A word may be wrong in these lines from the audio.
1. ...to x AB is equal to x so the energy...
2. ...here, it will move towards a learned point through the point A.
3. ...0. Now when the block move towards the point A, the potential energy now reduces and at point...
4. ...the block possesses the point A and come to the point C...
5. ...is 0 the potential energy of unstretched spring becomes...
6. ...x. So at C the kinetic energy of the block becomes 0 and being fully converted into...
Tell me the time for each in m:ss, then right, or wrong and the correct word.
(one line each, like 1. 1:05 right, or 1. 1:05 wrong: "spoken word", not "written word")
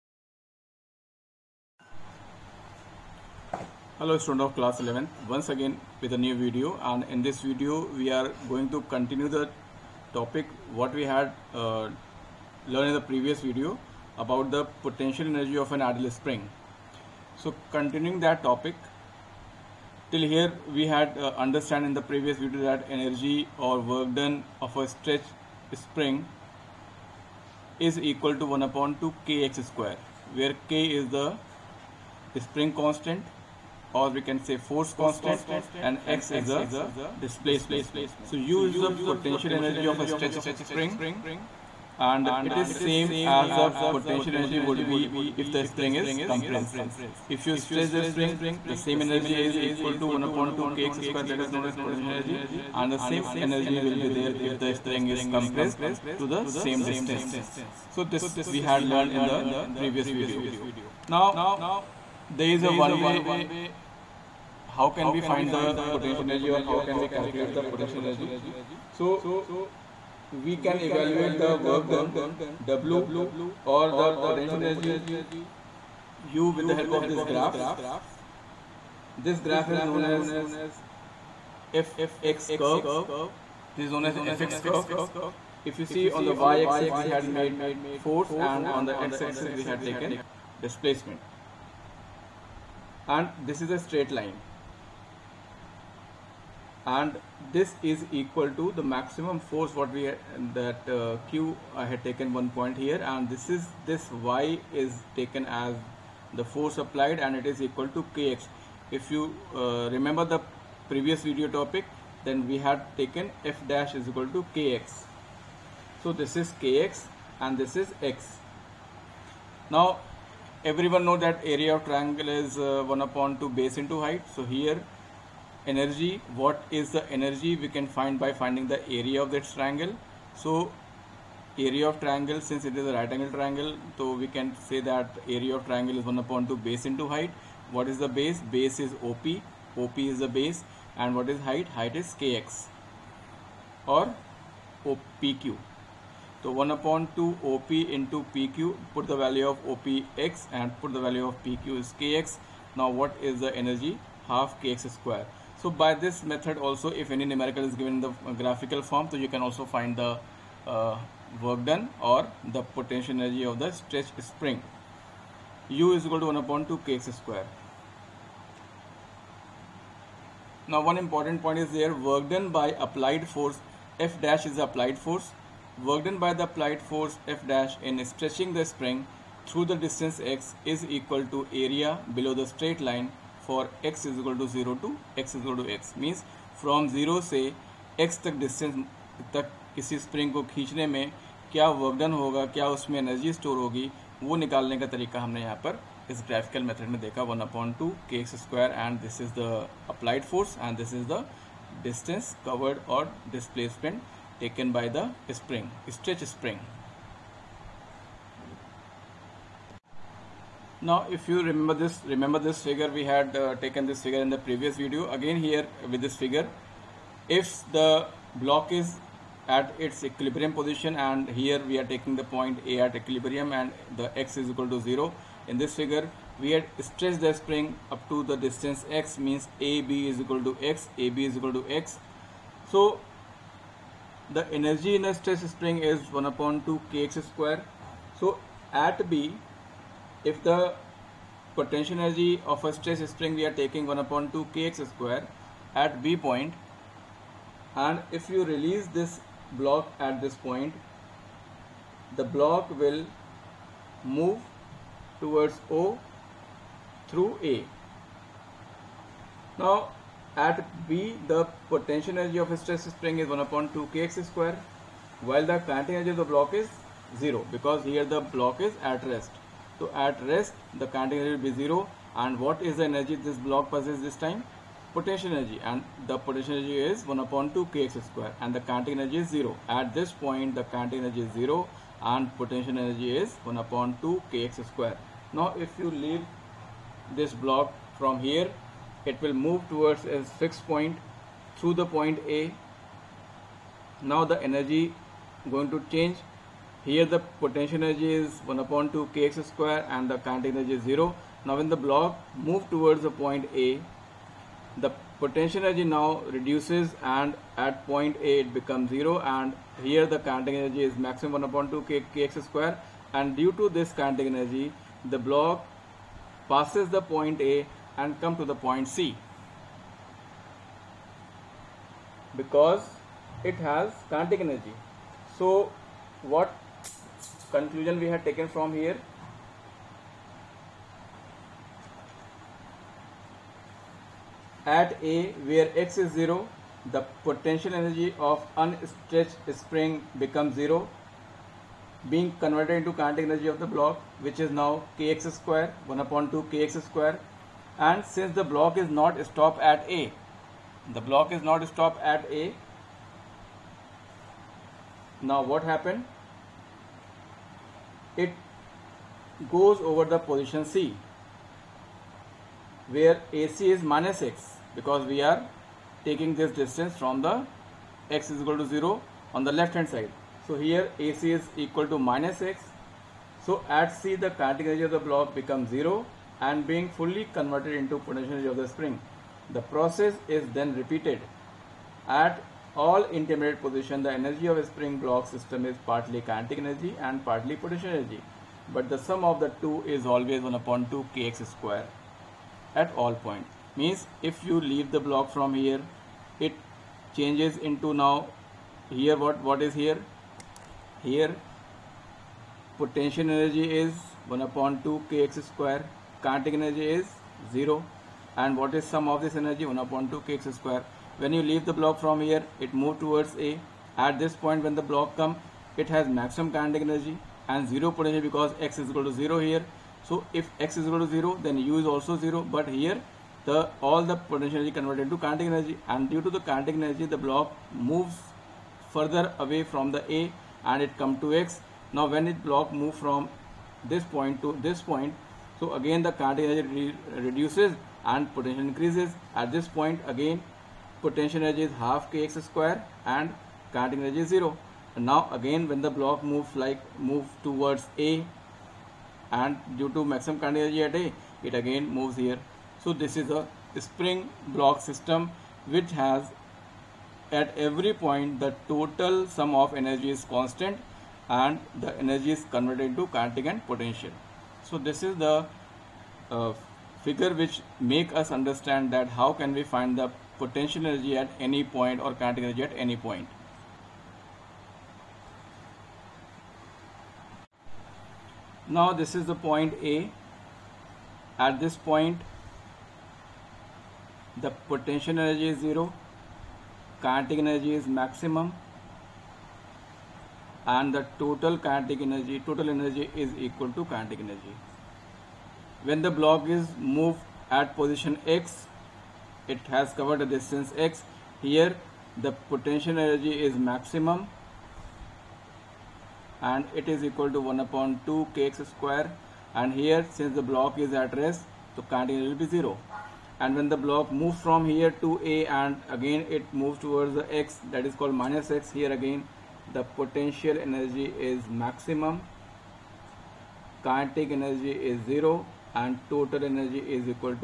1. 3:50 right
2. 4:48 wrong: "fixed", not "learned"
3. 5:00 right
4. 5:15 wrong: "passes", not "possesses"
5. 5:36 right
6. 6:12 right.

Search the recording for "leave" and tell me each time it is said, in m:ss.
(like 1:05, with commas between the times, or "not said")
4:45, 6:34, 6:51.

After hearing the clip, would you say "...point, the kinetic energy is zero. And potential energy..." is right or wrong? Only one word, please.
right.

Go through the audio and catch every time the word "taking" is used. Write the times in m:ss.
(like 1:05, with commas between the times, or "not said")
3:41, 4:03, 6:06.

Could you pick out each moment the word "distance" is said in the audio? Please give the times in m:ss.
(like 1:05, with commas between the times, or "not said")
0:56, 2:59, 3:48, 6:06, 8:20.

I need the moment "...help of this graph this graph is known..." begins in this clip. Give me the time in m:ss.
1:16.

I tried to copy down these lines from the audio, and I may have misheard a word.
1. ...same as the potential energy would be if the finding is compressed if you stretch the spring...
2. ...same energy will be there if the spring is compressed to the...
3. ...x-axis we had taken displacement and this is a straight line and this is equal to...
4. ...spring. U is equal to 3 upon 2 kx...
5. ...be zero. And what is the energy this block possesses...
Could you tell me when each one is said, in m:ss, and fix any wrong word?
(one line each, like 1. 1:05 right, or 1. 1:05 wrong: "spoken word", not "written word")
1. 0:42 wrong: "spring", not "finding"
2. 0:53 right
3. 1:29 right
4. 2:44 wrong: "1", not "3"
5. 4:31 right.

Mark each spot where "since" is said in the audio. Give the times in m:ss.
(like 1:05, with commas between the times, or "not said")
2:12, 5:48, 8:30.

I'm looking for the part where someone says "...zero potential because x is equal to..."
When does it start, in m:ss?
6:57.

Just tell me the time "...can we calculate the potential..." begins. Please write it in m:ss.
1:06.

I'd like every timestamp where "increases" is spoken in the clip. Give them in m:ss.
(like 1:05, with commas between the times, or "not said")
7:18.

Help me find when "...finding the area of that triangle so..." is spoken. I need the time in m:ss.
2:08.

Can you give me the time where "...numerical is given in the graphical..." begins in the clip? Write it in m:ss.
2:37.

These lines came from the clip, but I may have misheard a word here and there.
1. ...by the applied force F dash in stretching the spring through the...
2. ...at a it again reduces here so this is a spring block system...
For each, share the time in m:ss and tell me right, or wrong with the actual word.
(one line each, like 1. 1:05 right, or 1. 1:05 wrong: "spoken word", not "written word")
1. 2:56 right
2. 7:30 wrong: "moves", not "reduces".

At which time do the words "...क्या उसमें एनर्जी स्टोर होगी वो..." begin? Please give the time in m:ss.
3:12.